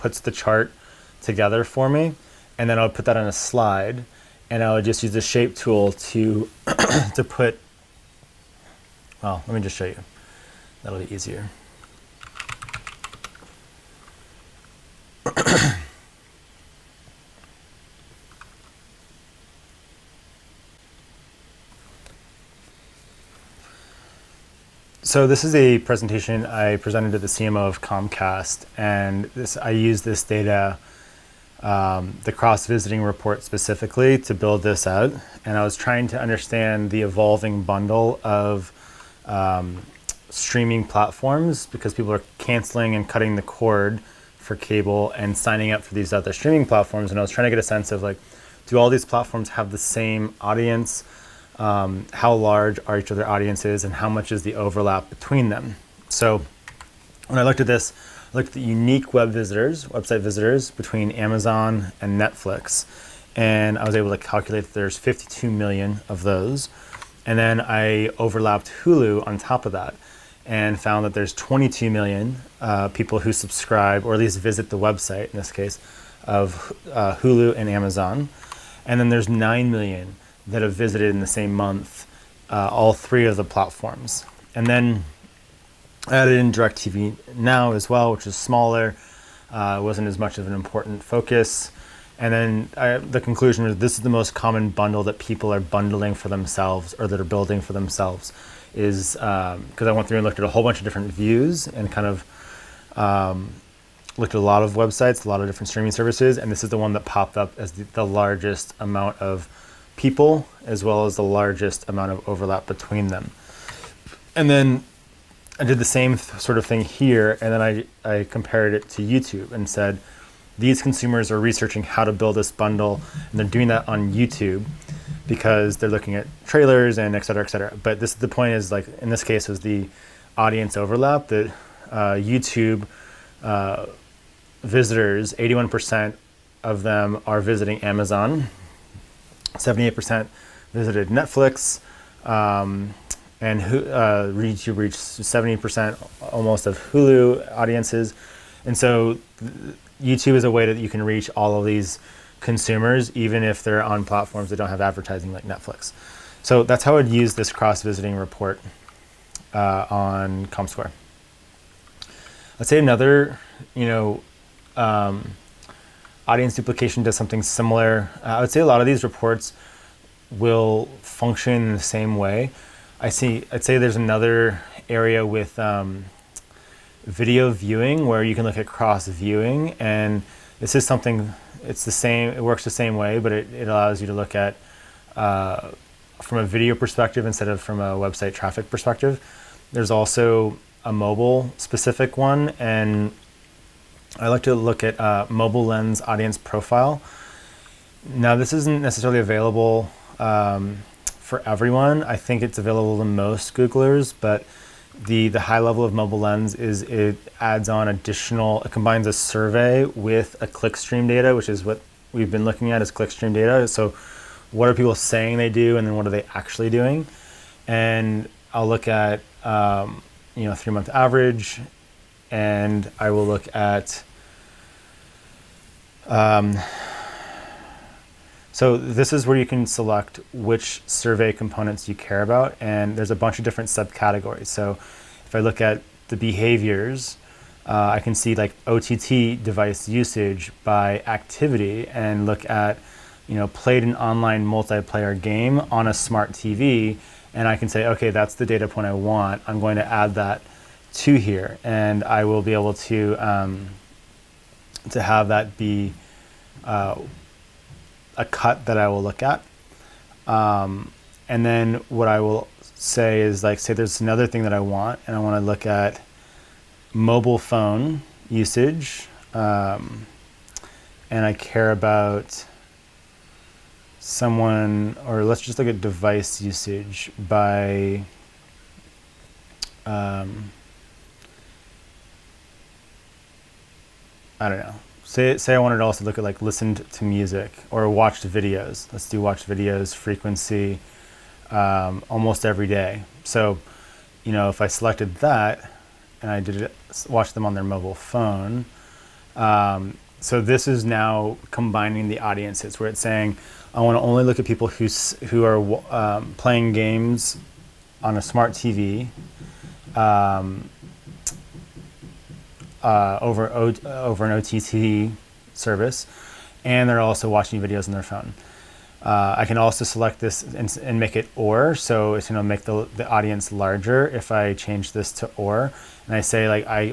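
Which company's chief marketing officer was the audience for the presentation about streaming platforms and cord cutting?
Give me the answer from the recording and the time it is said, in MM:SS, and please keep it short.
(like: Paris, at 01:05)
Comcast, at 00:27.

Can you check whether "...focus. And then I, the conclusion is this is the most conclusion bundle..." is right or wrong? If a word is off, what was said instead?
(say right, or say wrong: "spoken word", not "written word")
wrong: "common", not "conclusion".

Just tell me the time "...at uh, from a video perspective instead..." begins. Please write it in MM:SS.
03:04.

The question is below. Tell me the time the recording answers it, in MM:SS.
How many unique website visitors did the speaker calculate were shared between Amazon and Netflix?
01:04.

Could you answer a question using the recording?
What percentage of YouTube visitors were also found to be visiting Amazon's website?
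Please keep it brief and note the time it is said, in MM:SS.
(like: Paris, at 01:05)
81%, at 02:15.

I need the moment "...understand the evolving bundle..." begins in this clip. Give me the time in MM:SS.
00:36.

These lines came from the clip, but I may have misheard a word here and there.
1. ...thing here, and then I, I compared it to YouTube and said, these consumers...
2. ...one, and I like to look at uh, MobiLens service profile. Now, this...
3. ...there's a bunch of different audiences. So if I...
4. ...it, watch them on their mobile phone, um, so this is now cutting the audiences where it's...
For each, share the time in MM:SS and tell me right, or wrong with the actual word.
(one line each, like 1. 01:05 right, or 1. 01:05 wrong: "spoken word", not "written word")
1. 01:56 right
2. 03:12 wrong: "audience", not "service"
3. 03:52 wrong: "subcategories", not "audiences"
4. 04:56 wrong: "combining", not "cutting".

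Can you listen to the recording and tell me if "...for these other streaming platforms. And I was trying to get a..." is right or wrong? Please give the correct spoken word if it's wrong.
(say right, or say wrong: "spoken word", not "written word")
right.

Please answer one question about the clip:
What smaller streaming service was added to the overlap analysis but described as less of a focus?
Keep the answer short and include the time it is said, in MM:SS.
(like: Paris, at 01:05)
DirecTV Now, at 01:26.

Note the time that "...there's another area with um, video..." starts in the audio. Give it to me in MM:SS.
02:53.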